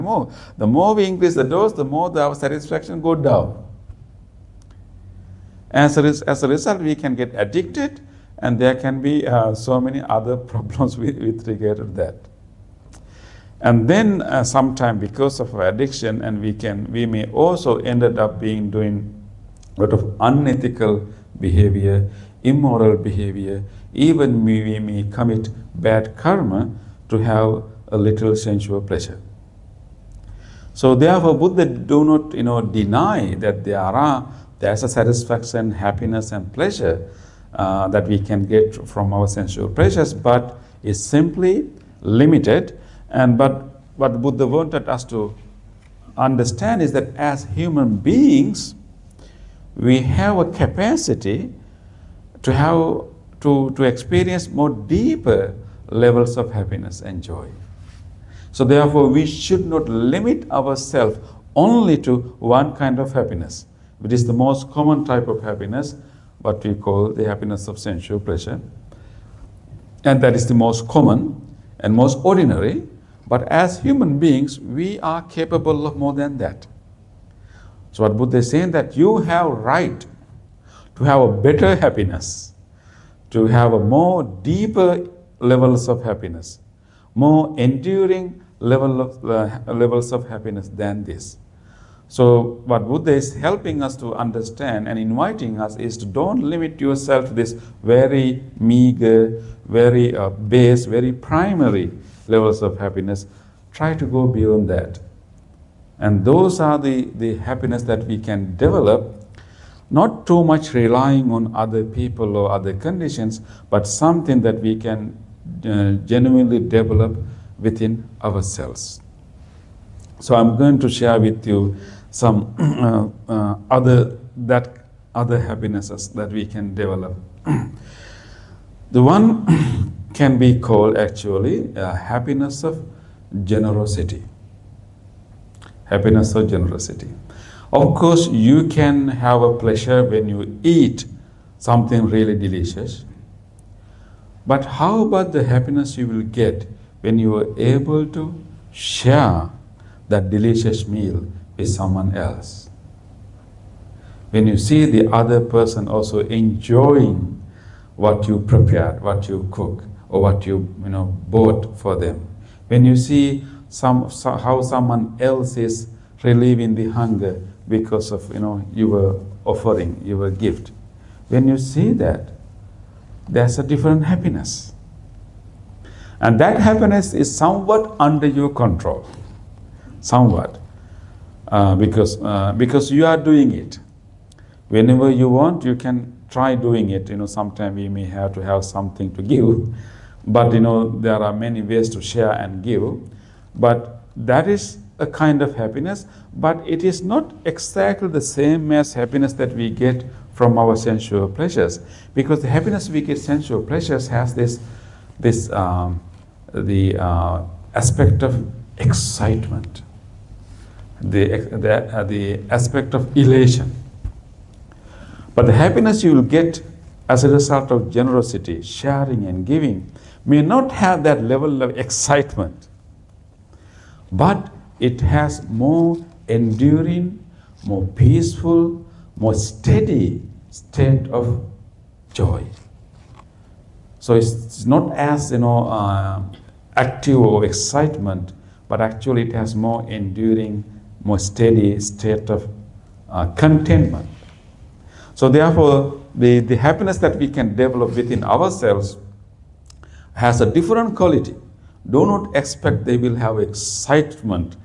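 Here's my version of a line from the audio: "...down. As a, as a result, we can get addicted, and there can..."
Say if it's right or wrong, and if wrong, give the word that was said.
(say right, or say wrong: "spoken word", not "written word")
right.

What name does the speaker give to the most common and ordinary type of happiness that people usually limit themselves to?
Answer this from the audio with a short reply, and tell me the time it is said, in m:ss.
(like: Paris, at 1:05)
Happiness of sensual pleasure, at 1:07.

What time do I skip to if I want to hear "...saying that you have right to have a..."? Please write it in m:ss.
1:18.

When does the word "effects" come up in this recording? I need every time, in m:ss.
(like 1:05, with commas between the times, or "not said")
not said.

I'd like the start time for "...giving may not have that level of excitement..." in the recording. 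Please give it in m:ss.
3:39.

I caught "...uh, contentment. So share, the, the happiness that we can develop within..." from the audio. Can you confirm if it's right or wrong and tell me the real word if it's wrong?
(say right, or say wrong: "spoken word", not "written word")
wrong: "therefore", not "share".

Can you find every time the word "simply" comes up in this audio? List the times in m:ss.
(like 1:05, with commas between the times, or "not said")
0:41.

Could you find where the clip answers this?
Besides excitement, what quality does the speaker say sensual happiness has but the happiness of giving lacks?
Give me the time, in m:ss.
3:33.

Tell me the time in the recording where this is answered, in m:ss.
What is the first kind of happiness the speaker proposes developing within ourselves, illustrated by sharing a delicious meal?
2:11.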